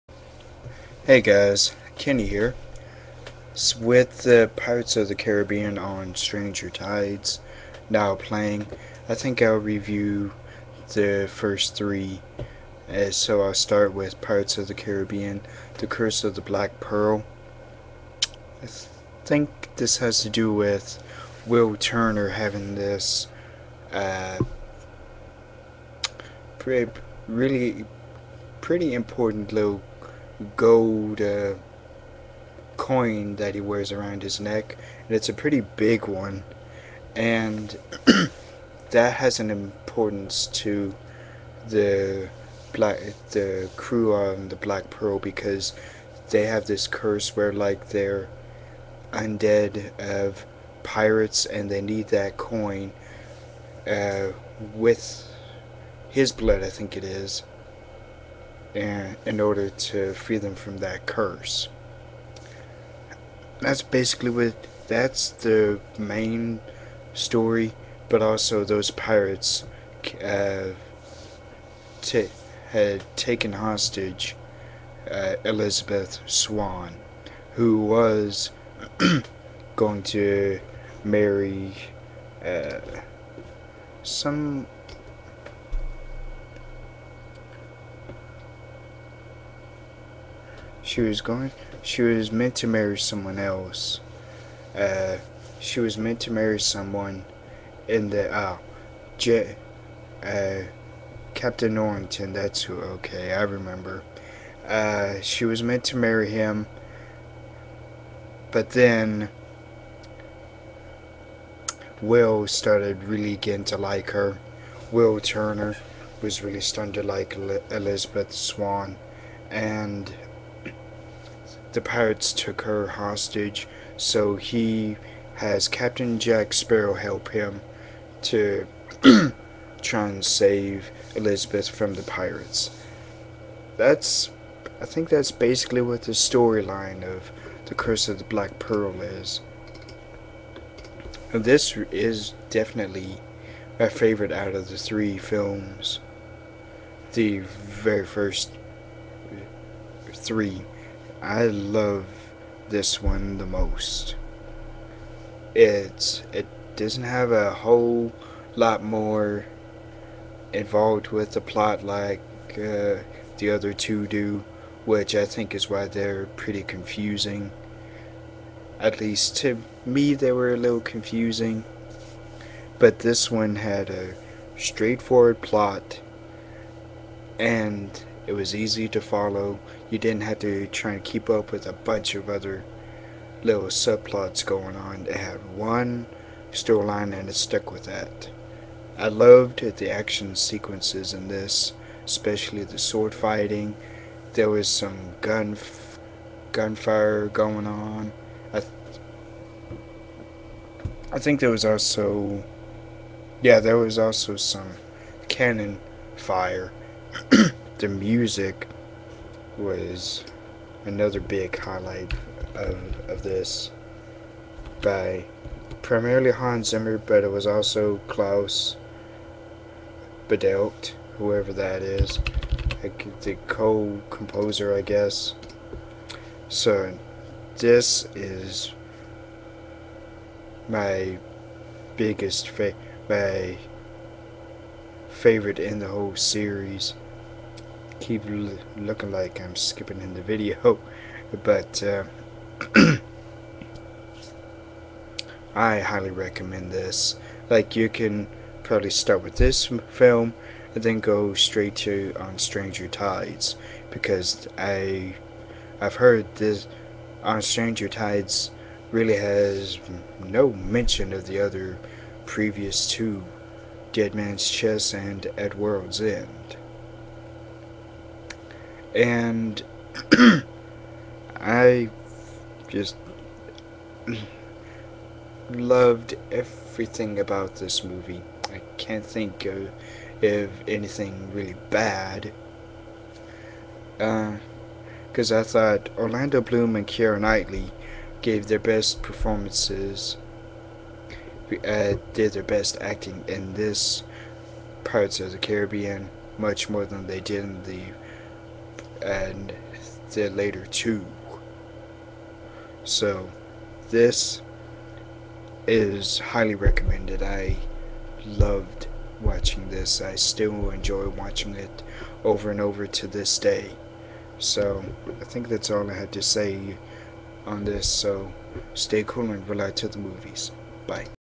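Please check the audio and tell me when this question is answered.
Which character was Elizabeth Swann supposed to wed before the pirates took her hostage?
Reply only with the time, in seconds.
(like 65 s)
101 s.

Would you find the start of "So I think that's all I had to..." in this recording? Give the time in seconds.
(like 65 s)
314 s.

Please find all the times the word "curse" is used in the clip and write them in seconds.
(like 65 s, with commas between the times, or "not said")
15 s, 46 s, 61 s, 137 s.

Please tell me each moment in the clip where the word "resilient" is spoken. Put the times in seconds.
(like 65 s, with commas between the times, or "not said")
not said.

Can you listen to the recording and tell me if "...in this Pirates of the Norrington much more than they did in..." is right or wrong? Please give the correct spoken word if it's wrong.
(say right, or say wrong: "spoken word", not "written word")
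wrong: "Caribbean", not "Norrington".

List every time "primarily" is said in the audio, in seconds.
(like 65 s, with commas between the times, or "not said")
215 s.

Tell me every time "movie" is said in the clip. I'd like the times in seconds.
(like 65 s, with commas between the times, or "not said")
277 s, 319 s.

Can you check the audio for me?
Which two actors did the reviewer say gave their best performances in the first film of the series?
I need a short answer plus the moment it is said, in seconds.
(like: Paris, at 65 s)
Orlando Bloom and Keira Knightley, at 285 s.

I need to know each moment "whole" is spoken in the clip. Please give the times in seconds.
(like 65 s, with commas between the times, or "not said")
157 s, 235 s.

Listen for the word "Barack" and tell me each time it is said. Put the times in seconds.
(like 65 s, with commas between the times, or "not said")
not said.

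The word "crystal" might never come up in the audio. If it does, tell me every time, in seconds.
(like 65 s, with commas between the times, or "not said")
not said.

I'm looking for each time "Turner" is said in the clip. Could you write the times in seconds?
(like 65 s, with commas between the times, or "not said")
21 s, 115 s.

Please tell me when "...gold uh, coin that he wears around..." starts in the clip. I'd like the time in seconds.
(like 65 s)
30 s.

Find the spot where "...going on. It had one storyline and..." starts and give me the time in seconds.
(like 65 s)
184 s.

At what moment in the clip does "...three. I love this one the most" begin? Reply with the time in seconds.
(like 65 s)
150 s.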